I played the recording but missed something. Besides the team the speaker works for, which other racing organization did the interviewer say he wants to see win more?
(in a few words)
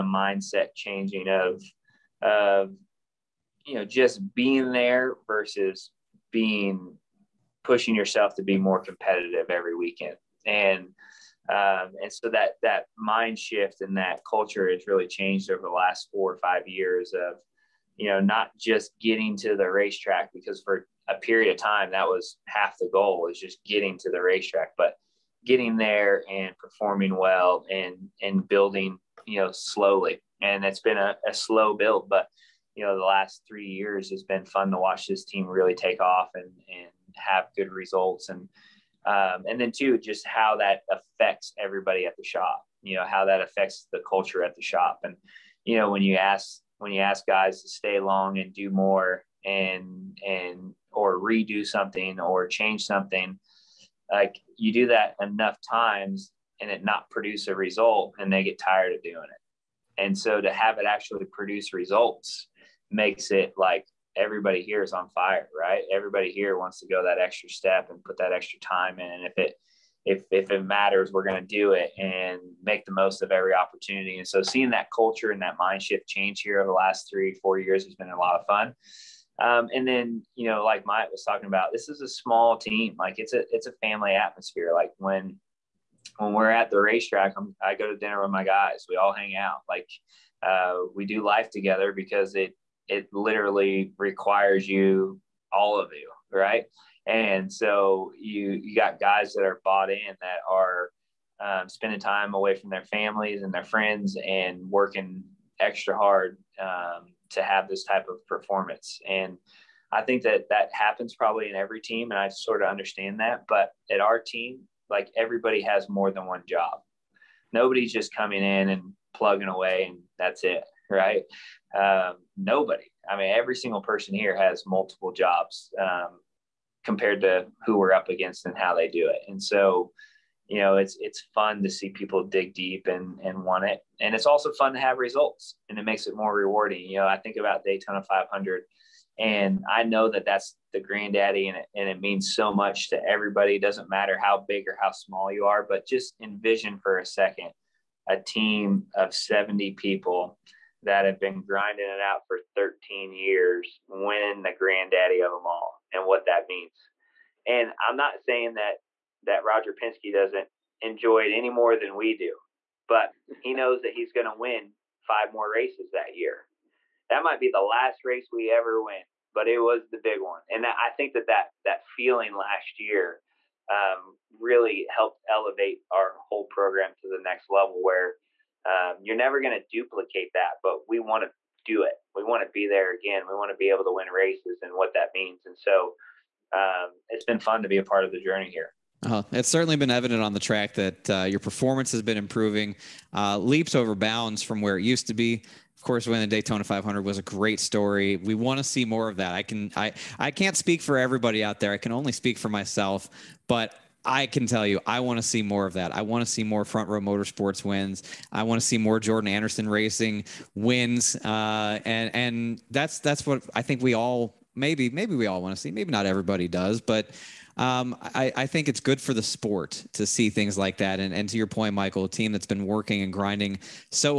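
Jordan Anderson Racing.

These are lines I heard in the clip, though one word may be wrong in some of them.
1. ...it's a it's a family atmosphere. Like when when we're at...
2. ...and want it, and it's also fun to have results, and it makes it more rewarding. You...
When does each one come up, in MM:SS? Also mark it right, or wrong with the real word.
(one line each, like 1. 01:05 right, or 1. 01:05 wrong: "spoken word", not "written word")
1. 01:23 right
2. 02:13 right.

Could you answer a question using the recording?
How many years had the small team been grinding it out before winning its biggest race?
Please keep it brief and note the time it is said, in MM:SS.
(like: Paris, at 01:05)
13, at 02:32.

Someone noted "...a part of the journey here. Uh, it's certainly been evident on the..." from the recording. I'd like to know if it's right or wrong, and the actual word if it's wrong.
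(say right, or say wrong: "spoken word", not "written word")
right.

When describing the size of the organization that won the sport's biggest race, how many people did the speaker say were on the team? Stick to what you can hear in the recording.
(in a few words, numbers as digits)
70.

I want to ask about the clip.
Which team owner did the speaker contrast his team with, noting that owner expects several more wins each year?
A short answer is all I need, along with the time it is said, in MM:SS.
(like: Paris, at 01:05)
Roger Penske, at 02:39.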